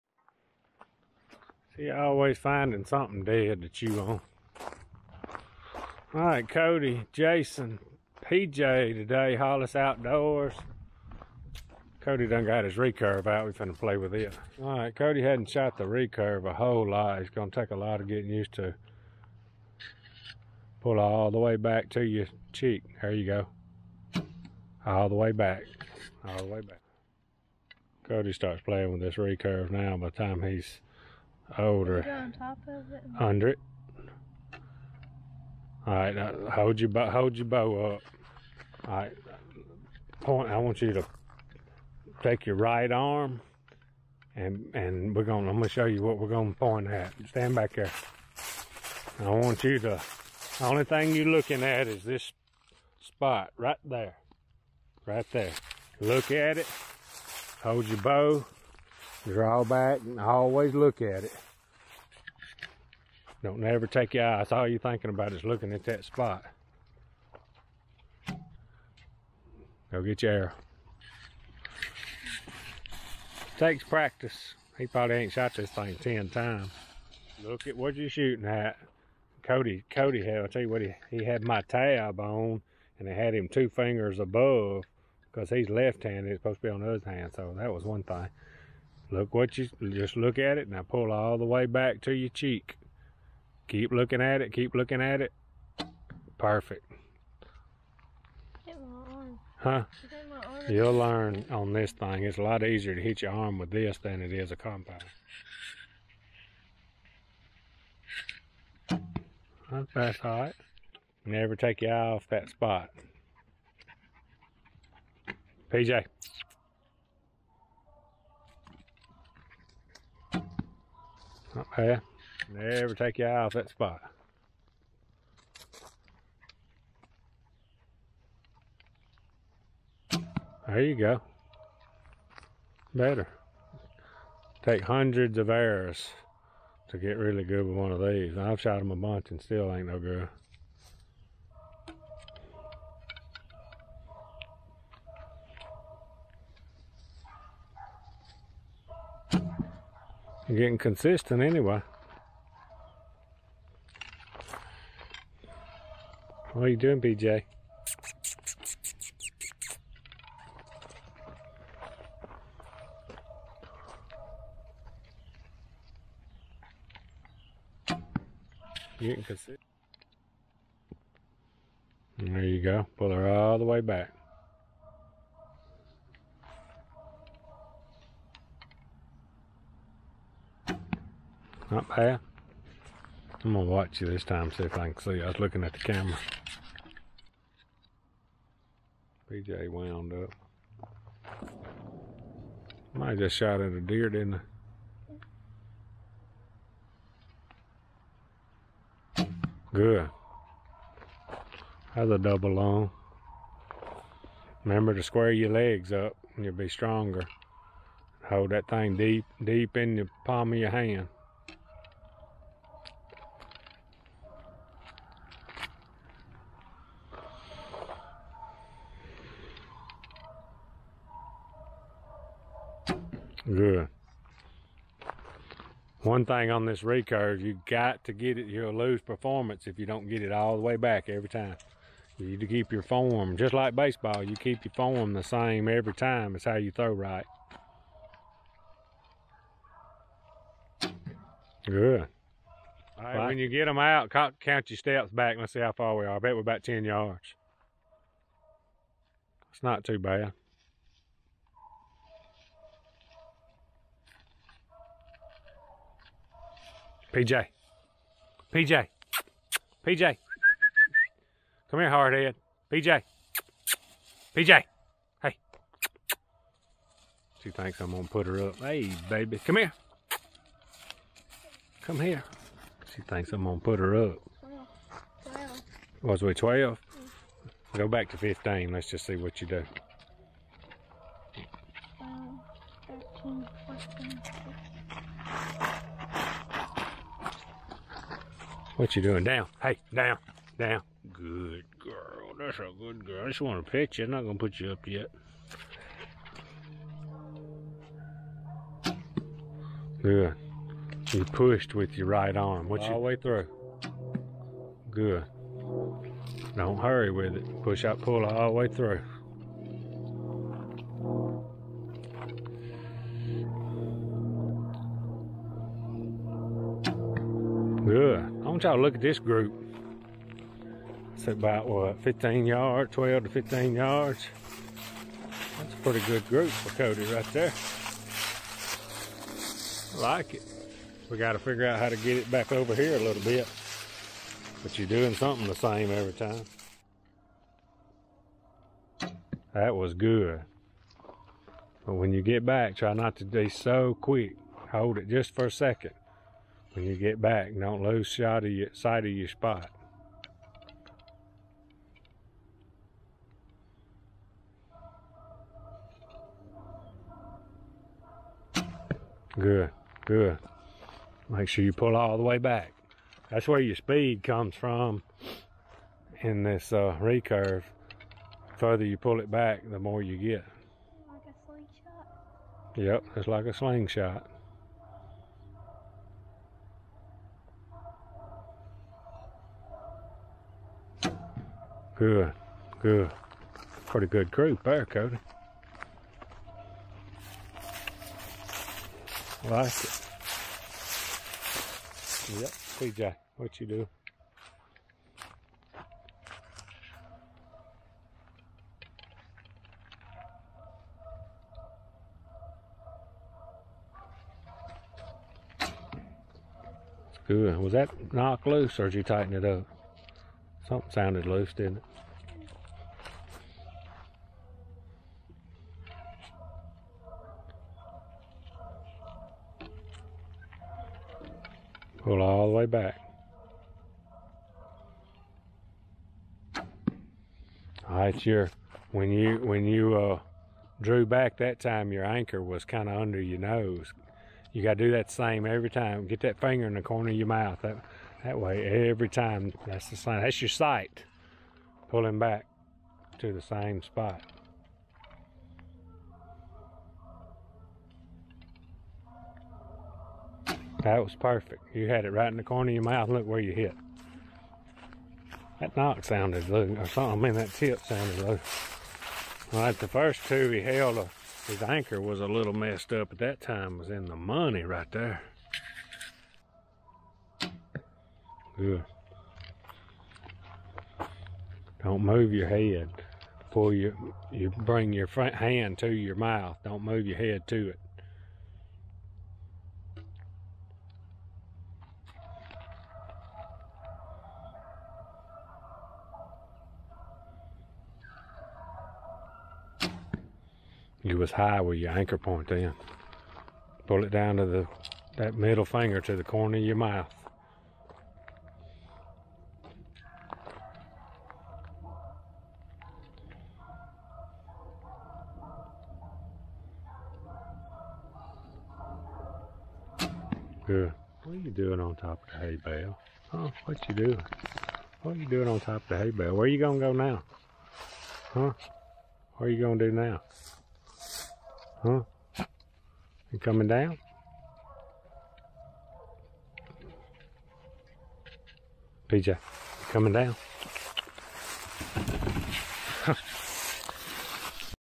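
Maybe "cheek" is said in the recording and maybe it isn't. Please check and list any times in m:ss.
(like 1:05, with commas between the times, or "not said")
0:22, 1:32.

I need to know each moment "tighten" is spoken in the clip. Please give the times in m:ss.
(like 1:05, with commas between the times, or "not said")
6:49.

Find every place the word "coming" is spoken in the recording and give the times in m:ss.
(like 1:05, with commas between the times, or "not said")
8:43, 8:49.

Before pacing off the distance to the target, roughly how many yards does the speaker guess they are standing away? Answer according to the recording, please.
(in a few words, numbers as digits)
10 yards.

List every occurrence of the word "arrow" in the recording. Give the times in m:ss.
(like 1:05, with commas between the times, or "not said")
1:10, 2:15.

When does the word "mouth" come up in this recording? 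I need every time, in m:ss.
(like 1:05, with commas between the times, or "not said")
7:17, 7:32, 7:56, 8:16.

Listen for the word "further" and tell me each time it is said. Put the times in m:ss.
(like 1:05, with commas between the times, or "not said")
6:08.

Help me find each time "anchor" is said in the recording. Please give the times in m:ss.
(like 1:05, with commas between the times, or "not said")
7:12, 7:41, 8:11.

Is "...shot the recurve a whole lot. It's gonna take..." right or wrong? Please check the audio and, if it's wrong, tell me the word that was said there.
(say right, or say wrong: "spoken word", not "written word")
right.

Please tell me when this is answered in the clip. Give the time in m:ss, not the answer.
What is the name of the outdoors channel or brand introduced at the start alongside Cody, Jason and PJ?
0:09.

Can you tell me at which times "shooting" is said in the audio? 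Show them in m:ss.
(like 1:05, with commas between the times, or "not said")
1:18.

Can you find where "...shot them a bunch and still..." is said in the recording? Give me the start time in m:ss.
2:18.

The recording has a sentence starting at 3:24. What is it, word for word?
Remember to square your legs up and you'll be stronger.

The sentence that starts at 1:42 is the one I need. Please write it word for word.
It's a lot easier to hit your arm with this than it is a compound.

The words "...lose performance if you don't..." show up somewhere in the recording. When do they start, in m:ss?
3:48.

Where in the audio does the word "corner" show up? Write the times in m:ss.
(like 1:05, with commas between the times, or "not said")
7:16, 7:32, 8:16.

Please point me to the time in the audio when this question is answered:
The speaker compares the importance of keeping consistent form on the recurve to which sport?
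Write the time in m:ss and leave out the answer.
3:53.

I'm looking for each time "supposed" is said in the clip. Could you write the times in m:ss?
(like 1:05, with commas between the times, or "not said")
1:26.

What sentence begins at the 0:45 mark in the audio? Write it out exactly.
I'm gonna show you what we're gonna point at.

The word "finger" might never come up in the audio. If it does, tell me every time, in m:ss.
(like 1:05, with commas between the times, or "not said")
1:23, 7:16, 8:15.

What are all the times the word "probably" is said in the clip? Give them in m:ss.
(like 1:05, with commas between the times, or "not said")
1:14.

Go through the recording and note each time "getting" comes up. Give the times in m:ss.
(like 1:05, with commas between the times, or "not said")
0:18, 2:30.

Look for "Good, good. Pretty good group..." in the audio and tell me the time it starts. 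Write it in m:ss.
6:22.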